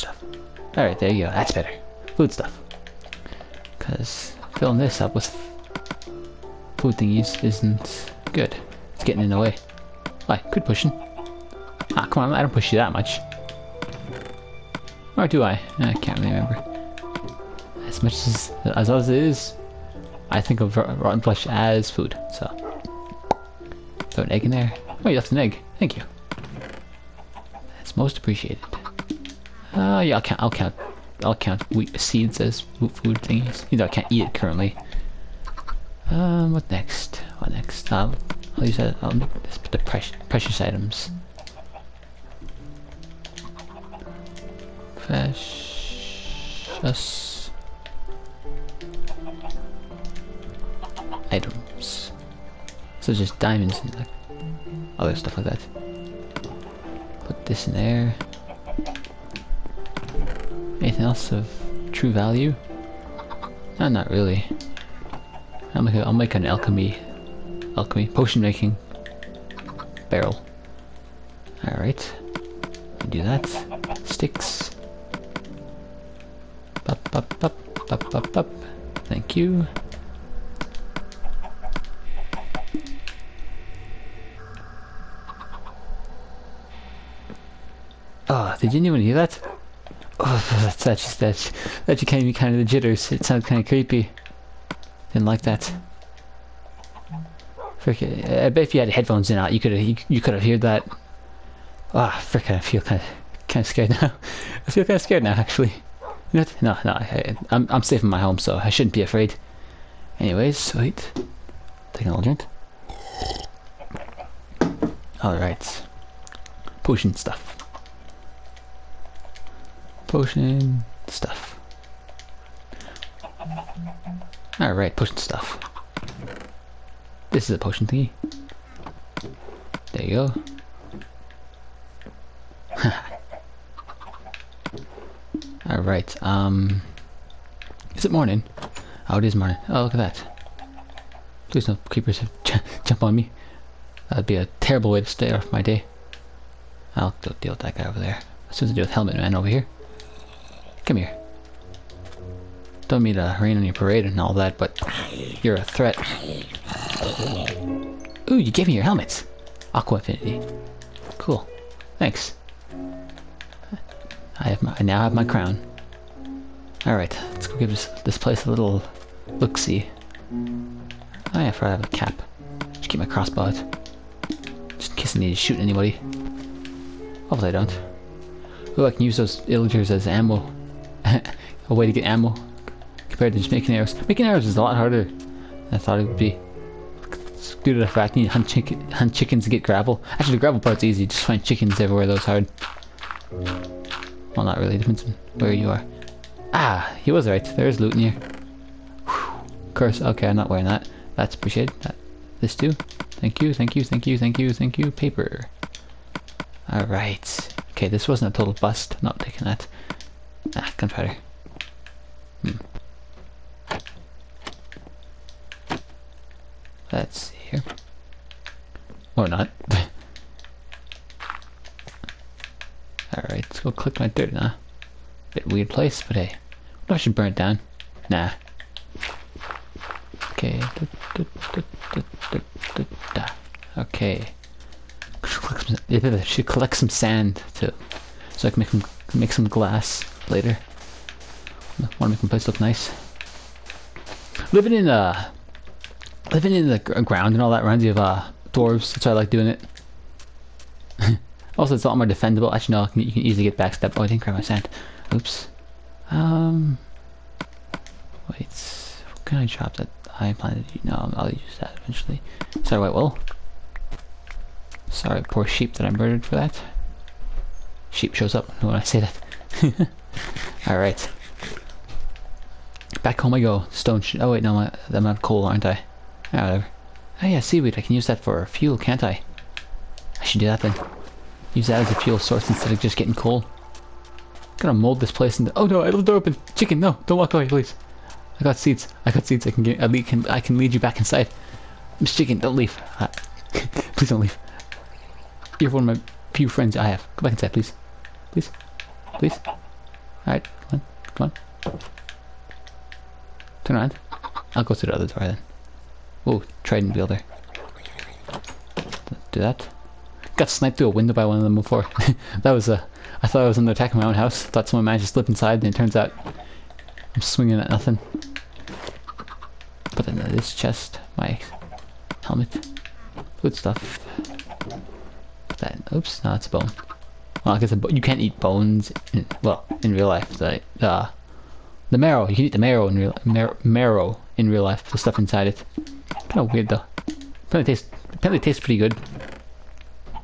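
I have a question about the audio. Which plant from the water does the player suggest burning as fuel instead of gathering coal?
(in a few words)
seaweed.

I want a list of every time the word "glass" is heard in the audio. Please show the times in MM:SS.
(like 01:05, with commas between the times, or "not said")
03:59.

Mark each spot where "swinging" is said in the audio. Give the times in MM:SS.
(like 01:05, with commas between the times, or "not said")
05:17.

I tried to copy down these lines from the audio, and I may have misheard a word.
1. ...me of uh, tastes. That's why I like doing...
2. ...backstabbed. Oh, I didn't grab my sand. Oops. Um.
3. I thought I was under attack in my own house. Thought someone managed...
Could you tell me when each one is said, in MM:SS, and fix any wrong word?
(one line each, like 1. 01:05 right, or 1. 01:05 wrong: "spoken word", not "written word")
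1. 04:07 wrong: "dwarves", not "tastes"
2. 04:13 right
3. 05:13 right.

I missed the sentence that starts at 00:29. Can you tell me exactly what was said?
Uh, yeah, I'll count, I'll count, I'll count wheat seeds as food thingies.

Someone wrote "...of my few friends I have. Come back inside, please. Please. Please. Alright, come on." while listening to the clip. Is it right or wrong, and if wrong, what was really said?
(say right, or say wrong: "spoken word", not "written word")
right.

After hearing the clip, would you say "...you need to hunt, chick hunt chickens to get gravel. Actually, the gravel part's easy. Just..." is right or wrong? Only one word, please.
right.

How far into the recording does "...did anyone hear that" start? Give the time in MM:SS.
01:28.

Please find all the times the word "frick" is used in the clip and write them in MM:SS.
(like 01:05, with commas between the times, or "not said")
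01:37, 01:42.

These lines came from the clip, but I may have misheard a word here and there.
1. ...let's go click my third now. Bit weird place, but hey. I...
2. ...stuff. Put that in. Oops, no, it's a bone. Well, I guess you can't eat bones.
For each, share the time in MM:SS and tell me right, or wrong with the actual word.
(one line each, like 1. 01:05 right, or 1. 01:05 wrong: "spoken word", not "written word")
1. 03:43 right
2. 05:23 right.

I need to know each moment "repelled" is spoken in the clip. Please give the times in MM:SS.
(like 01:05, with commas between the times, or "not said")
not said.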